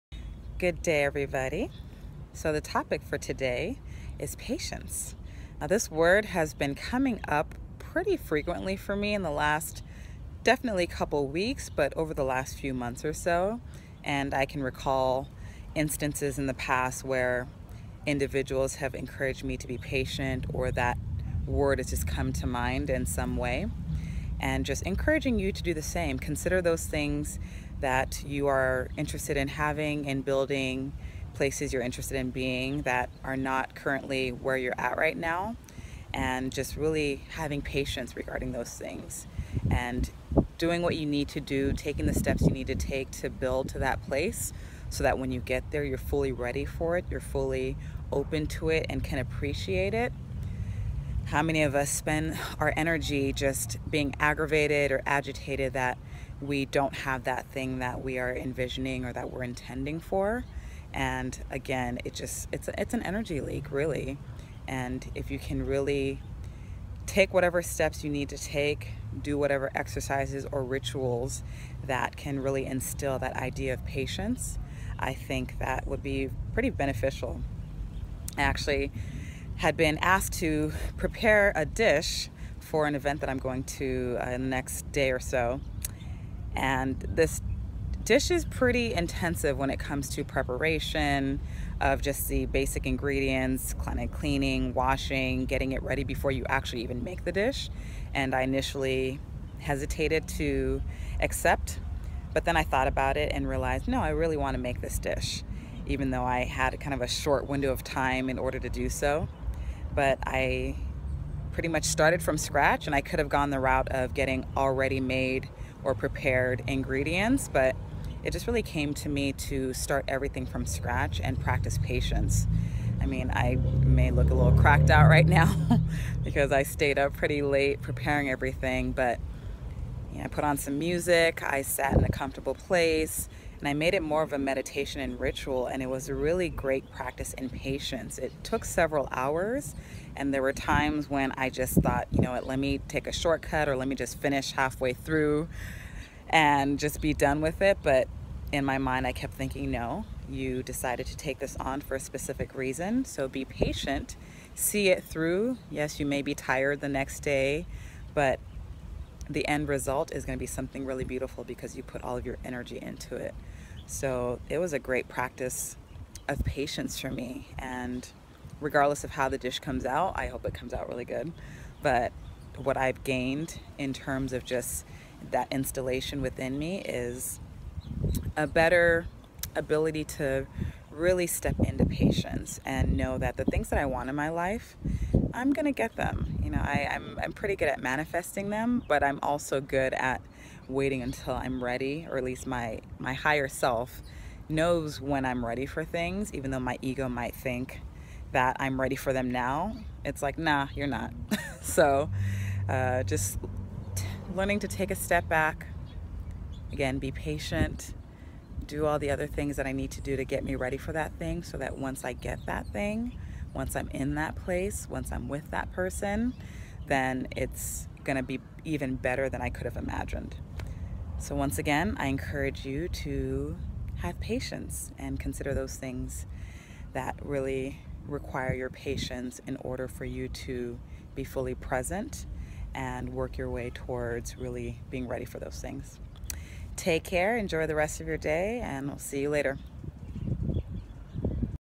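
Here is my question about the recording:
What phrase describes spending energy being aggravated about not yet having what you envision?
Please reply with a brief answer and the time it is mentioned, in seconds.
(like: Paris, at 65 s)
energy leak, at 63 s.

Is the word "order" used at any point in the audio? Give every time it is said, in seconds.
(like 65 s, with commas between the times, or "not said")
108 s, 229 s.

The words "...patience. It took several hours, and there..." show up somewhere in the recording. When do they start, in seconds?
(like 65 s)
137 s.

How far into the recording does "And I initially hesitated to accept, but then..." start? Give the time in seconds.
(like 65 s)
98 s.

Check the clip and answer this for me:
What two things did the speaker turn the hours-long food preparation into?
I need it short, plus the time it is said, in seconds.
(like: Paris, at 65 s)
meditation and ritual, at 134 s.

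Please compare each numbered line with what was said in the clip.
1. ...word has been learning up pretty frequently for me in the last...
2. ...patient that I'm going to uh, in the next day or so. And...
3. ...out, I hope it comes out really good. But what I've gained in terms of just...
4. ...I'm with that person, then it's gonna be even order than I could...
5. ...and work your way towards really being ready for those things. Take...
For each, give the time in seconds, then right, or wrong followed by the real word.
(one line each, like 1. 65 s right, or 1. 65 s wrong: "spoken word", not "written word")
1. 5 s wrong: "coming", not "learning"
2. 82 s wrong: "event", not "patient"
3. 169 s right
4. 215 s wrong: "better", not "order"
5. 232 s right.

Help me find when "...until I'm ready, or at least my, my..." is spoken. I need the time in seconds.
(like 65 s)
191 s.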